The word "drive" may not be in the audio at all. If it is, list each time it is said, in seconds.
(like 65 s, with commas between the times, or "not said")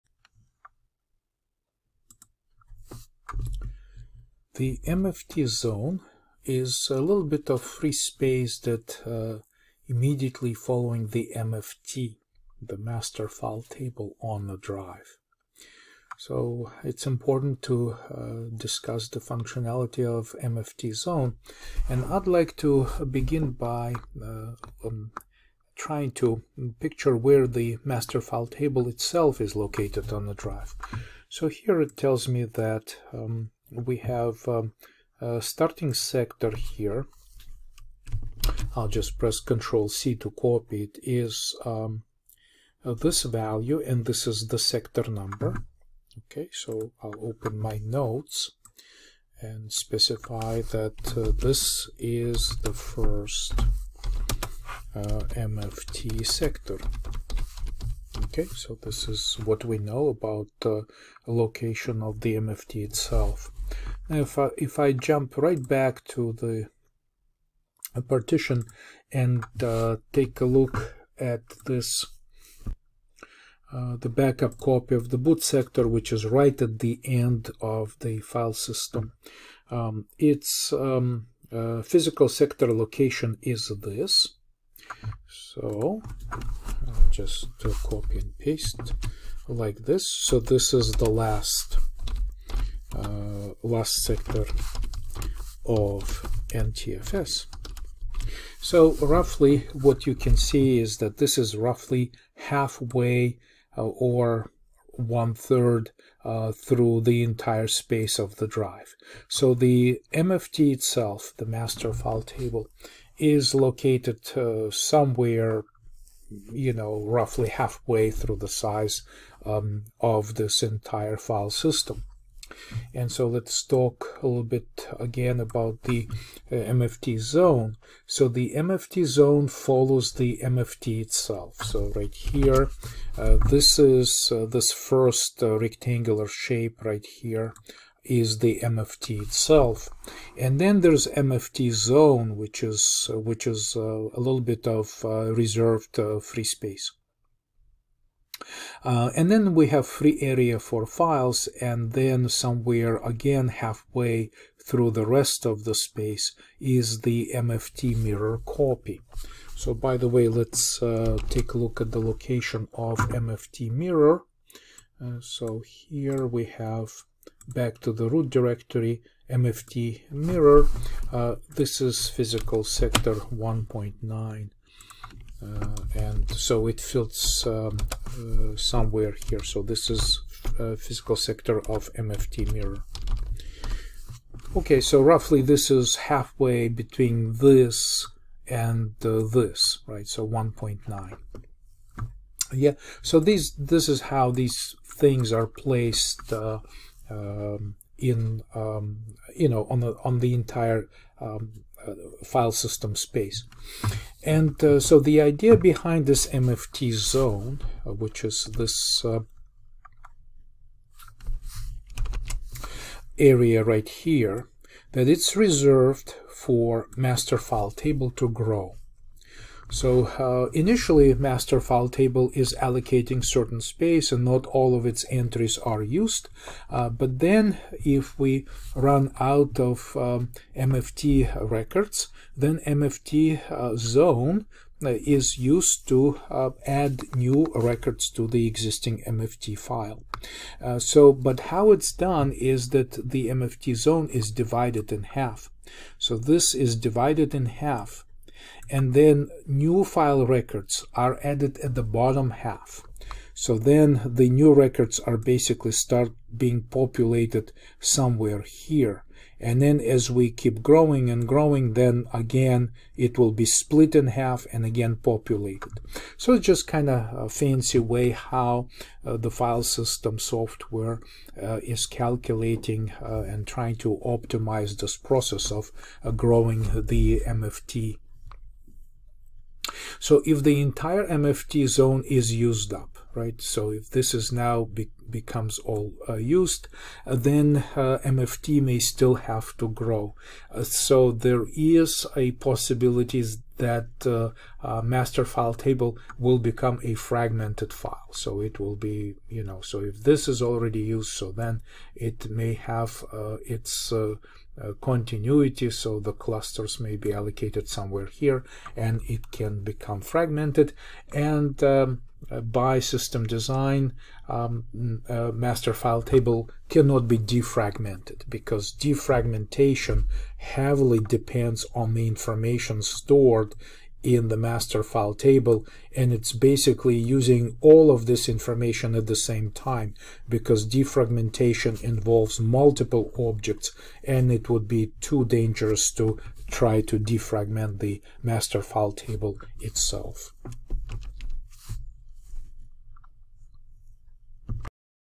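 14 s, 30 s, 108 s.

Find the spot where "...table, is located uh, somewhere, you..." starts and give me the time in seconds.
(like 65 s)
112 s.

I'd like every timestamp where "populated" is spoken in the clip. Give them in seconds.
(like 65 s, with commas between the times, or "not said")
256 s, 264 s.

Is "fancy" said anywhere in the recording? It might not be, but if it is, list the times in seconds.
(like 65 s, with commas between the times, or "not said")
267 s.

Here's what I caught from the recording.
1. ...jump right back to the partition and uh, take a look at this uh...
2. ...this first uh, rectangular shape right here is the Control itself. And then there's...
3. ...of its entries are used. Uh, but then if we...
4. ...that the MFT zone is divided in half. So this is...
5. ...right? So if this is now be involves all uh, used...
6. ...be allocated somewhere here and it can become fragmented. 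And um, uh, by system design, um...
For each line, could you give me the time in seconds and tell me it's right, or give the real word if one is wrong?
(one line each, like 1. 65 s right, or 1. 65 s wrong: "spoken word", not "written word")
1. 64 s right
2. 134 s wrong: "MFT", not "Control"
3. 224 s right
4. 242 s right
5. 283 s wrong: "becomes", not "involves"
6. 306 s right.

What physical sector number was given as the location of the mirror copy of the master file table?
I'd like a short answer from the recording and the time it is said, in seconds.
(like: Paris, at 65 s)
1.9, at 172 s.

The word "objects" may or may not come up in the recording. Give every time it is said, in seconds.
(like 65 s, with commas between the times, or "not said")
333 s.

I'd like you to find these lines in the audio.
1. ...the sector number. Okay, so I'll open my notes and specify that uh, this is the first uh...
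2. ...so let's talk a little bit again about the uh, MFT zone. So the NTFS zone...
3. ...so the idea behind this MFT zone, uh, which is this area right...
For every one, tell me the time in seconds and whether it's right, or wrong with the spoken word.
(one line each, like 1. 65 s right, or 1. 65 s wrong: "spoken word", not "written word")
1. 44 s right
2. 123 s wrong: "MFT", not "NTFS"
3. 204 s right.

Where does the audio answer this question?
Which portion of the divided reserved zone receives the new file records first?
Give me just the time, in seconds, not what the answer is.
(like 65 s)
251 s.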